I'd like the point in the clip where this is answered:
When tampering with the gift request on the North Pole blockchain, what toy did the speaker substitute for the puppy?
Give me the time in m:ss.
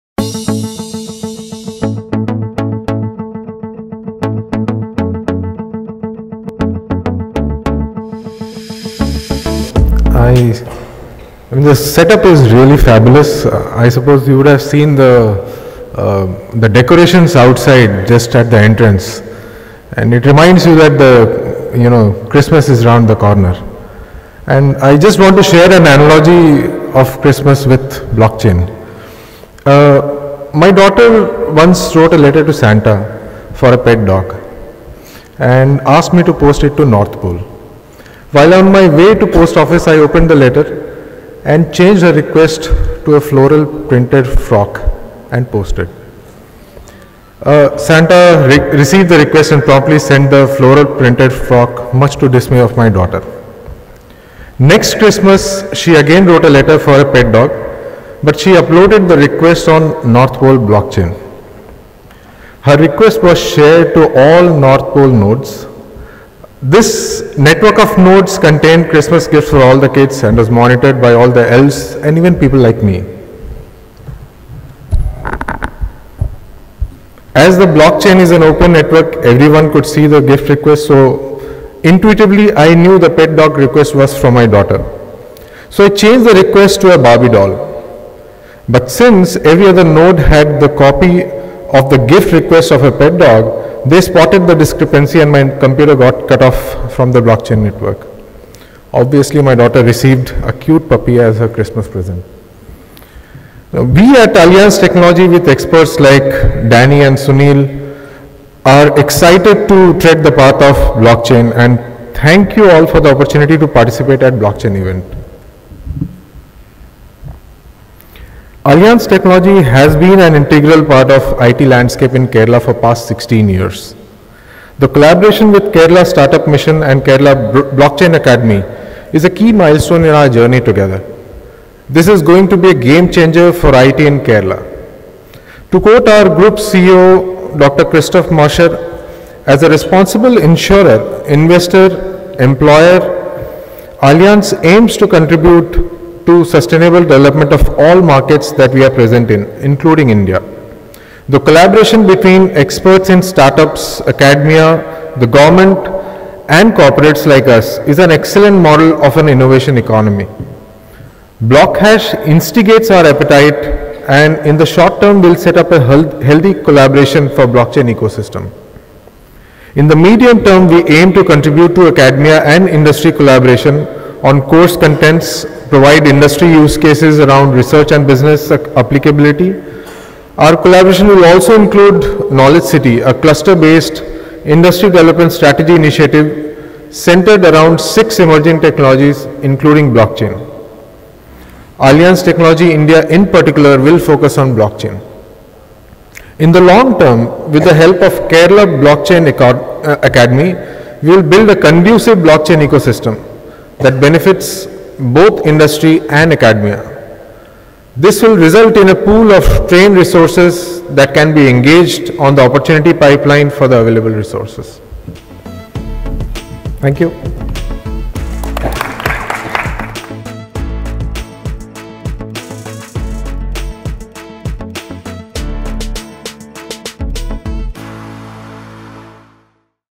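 1:26.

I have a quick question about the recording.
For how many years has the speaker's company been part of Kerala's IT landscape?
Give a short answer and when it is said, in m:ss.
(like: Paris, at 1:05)
16, at 2:03.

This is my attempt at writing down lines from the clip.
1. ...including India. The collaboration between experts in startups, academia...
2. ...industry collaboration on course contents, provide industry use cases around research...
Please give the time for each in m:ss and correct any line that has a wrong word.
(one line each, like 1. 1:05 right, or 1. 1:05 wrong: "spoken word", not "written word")
1. 2:29 right
2. 2:52 right.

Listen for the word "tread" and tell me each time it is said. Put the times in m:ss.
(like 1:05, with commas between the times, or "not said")
1:49.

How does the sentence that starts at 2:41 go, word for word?
Blockhash instigates our appetite and in the short term will set up a healthy collaboration for blockchain ecosystem.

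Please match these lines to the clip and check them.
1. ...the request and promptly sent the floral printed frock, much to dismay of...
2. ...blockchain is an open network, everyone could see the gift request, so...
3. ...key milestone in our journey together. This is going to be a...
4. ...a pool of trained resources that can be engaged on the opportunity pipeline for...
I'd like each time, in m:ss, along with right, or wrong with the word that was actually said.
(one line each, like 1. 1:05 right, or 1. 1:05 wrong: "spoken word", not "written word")
1. 0:49 right
2. 1:17 right
3. 2:09 right
4. 3:28 right.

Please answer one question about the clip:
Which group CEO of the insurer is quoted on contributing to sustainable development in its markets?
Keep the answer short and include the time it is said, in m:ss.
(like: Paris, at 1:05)
Dr. Christof Mascher, at 2:17.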